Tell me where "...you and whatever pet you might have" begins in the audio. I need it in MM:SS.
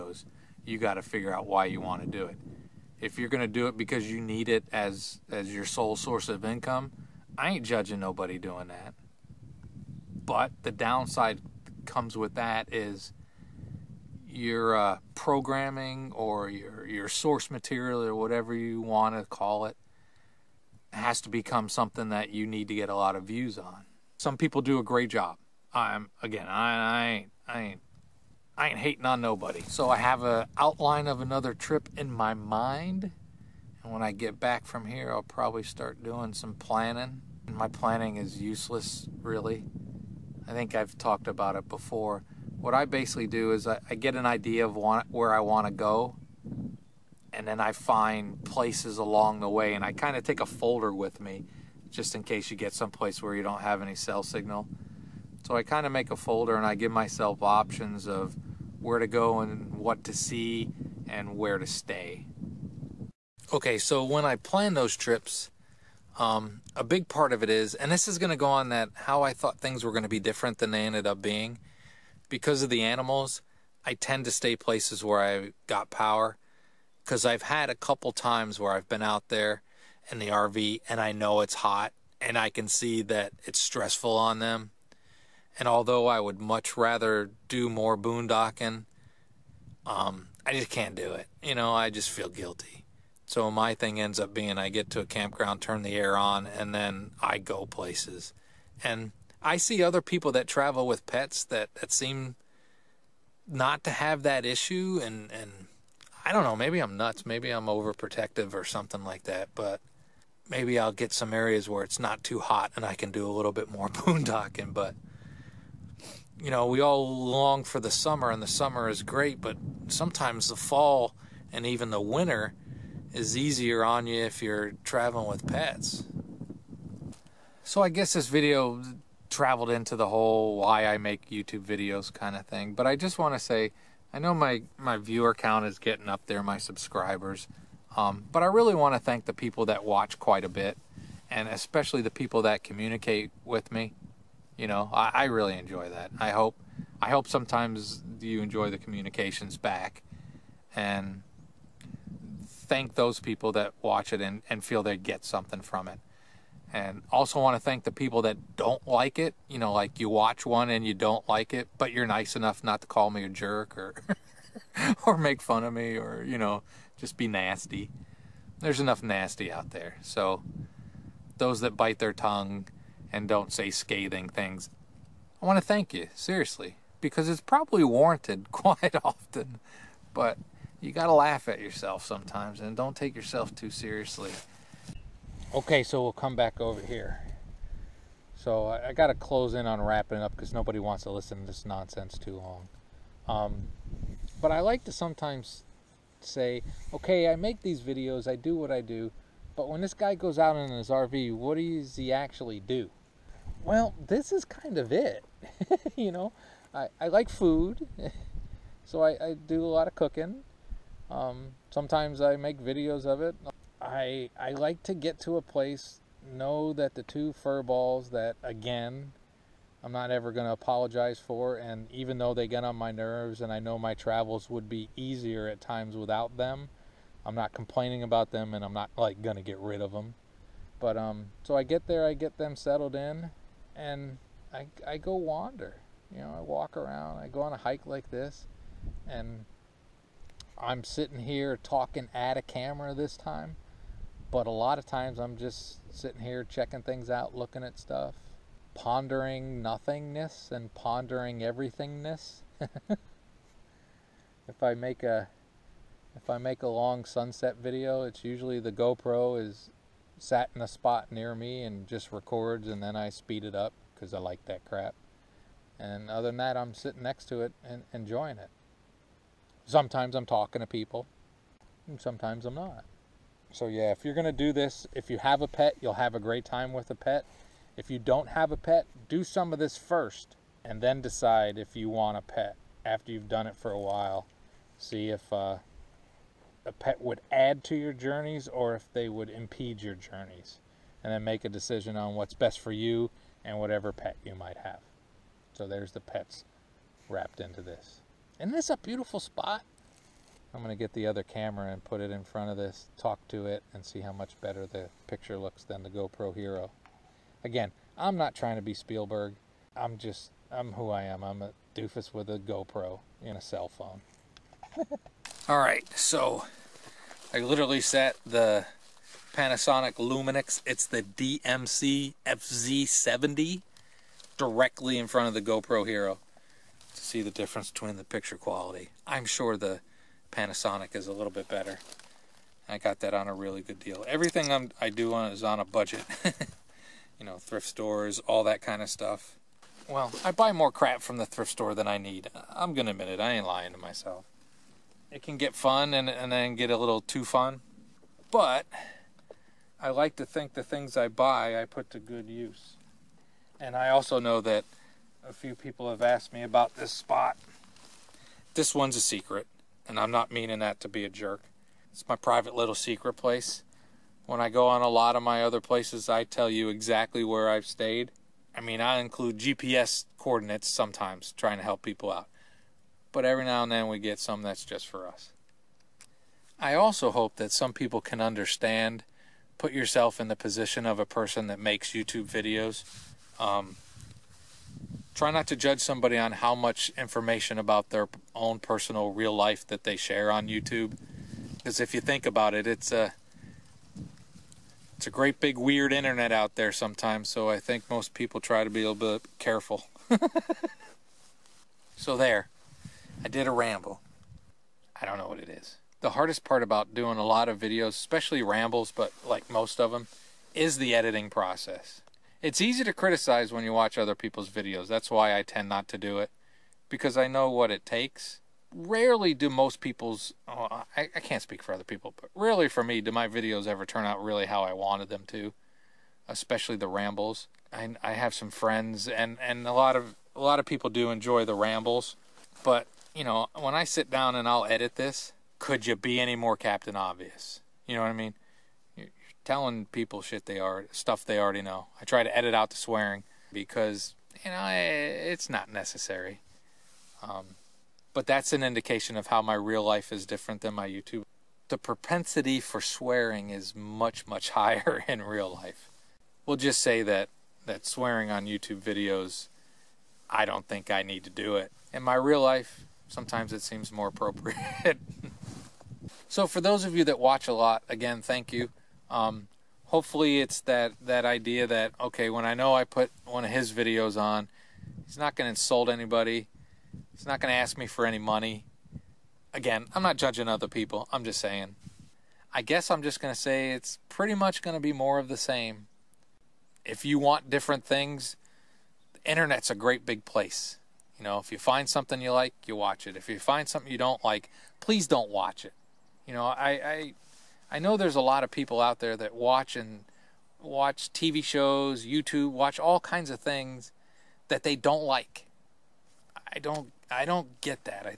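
04:52.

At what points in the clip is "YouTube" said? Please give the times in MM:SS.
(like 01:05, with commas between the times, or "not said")
02:11, 06:21, 06:30, 07:30, 07:38, 08:22.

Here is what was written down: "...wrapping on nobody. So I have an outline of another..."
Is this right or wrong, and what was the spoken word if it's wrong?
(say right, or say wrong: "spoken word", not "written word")
wrong: "hating", not "wrapping".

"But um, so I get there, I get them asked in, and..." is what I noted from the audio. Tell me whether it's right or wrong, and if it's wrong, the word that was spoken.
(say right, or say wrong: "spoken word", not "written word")
wrong: "settled", not "asked".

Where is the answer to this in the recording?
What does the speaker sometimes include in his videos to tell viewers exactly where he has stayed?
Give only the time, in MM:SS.
06:09.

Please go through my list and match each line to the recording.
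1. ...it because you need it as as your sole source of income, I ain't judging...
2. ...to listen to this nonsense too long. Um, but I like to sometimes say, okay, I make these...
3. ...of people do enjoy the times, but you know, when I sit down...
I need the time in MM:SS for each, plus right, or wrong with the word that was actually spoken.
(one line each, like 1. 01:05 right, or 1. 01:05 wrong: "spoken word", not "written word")
1. 00:03 right
2. 03:11 right
3. 07:10 wrong: "rambles", not "times".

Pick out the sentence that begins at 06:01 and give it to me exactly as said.
It's my private little secret place.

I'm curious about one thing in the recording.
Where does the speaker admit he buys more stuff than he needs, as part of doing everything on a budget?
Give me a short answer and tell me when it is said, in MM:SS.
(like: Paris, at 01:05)
Thrift stores, at 05:37.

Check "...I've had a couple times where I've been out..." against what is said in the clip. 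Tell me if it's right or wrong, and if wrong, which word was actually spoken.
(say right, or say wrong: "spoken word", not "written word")
right.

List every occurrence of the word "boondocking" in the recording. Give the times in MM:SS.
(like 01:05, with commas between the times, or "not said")
01:27, 01:53.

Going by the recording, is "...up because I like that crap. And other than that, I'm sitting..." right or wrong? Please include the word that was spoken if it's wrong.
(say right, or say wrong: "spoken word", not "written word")
right.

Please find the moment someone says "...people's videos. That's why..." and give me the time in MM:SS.
06:54.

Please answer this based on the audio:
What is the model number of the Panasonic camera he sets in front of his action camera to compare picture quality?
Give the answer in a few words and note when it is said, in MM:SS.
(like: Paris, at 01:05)
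DMC FZ70, at 05:21.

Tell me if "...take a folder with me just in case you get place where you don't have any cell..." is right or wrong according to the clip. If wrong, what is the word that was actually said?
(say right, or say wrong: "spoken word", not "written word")
wrong: "someplace", not "place".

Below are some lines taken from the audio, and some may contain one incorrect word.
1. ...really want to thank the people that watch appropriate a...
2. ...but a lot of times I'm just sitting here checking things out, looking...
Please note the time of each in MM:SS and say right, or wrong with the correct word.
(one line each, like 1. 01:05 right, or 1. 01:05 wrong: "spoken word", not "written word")
1. 02:18 wrong: "quite", not "appropriate"
2. 04:04 right.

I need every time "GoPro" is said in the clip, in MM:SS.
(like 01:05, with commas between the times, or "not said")
04:18, 05:05, 05:12, 05:25.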